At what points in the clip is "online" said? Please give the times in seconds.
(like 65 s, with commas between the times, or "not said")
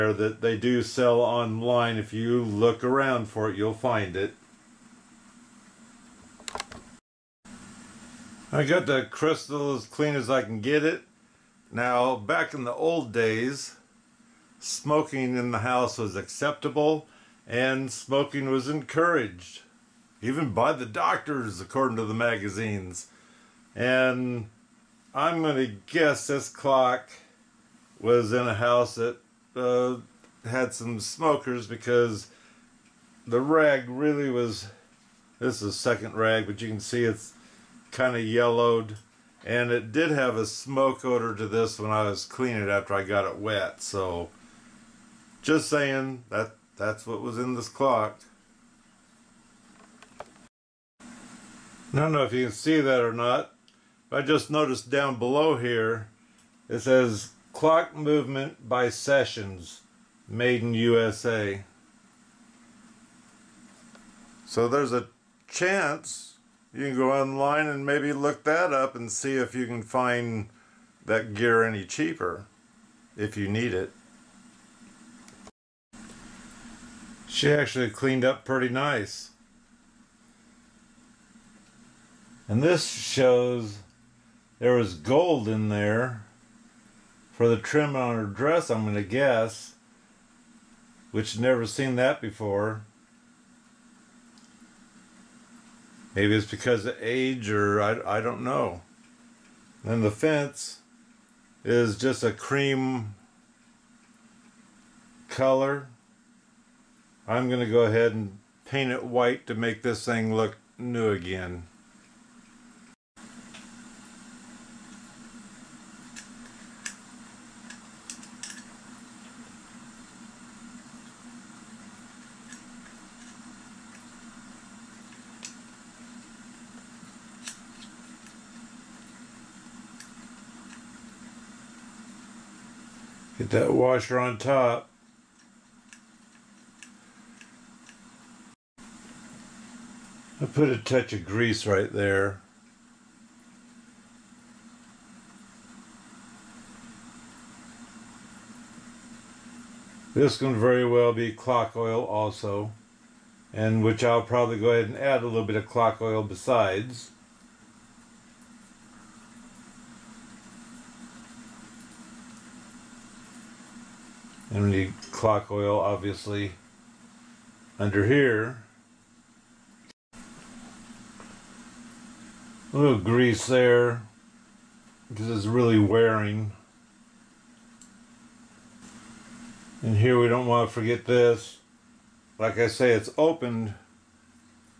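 1 s, 67 s.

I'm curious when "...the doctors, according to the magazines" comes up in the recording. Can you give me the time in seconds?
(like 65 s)
20 s.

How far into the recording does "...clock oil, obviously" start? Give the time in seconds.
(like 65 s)
165 s.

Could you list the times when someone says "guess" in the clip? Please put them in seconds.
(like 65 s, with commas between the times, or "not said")
25 s, 89 s.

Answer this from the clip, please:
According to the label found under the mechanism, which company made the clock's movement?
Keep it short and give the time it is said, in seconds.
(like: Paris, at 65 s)
Sessions, at 58 s.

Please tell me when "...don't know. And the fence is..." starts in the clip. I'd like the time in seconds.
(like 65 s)
98 s.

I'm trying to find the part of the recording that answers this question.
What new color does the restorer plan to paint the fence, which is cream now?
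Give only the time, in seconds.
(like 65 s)
109 s.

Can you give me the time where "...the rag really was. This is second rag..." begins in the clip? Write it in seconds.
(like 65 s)
33 s.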